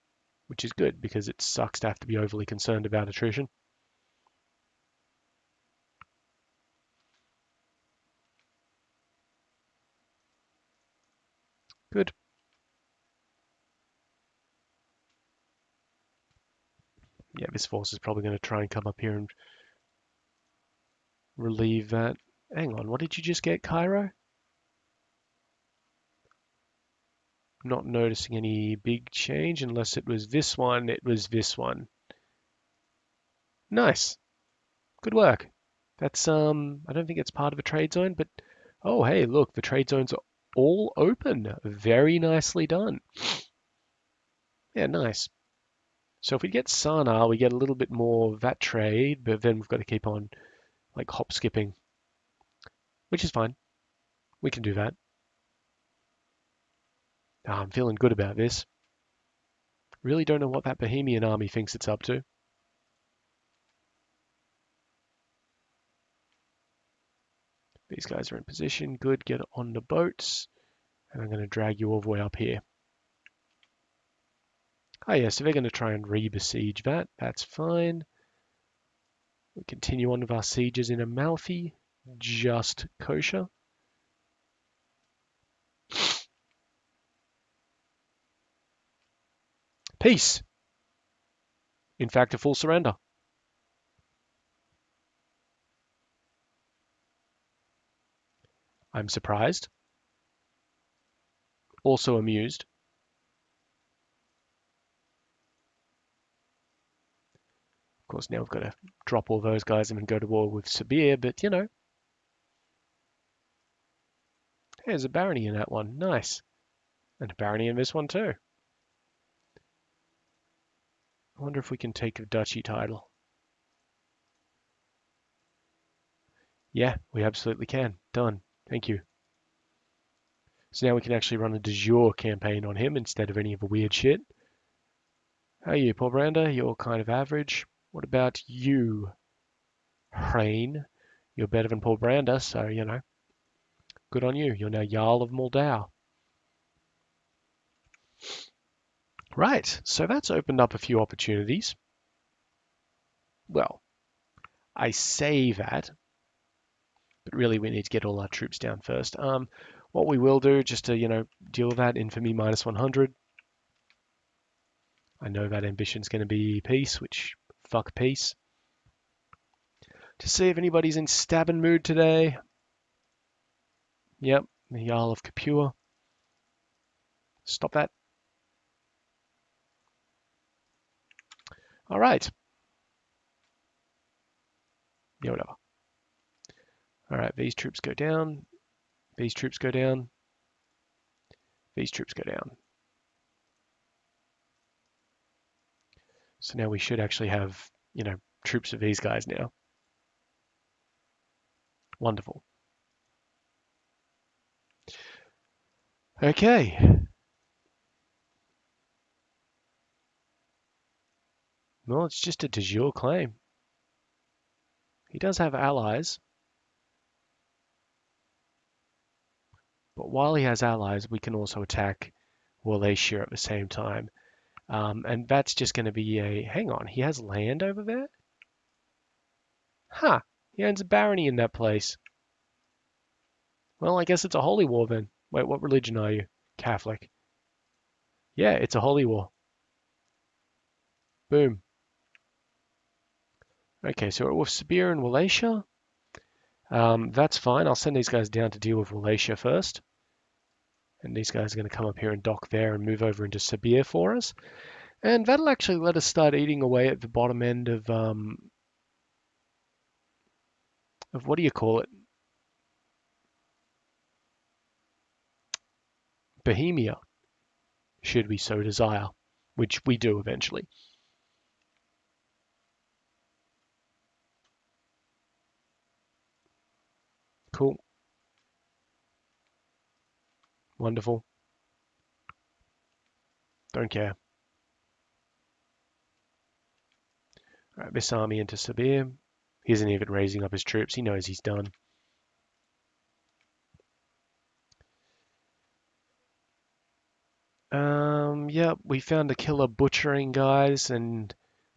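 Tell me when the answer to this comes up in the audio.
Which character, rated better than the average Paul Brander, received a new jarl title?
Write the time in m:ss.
2:20.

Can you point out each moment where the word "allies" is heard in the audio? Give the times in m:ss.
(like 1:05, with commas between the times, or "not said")
3:35, 3:40.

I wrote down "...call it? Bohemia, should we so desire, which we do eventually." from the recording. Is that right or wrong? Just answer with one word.
right.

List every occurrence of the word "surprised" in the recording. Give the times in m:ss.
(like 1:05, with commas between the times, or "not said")
1:39.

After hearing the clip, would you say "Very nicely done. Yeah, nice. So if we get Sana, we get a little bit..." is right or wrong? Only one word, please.
right.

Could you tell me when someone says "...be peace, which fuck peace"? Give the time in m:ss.
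2:46.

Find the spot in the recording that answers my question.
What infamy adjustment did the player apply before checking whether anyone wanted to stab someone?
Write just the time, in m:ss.
2:41.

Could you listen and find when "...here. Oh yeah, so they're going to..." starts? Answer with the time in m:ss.
1:12.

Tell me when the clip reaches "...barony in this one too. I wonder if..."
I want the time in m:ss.
1:57.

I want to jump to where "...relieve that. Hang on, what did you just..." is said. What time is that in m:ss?
0:21.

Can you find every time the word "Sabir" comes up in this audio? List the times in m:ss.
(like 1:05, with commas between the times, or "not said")
1:50, 4:04, 4:13, 4:48.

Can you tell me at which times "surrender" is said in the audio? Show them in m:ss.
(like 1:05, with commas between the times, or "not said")
1:32.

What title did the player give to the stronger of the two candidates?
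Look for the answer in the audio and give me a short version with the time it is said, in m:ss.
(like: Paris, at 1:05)
Jarl of Moldau, at 2:24.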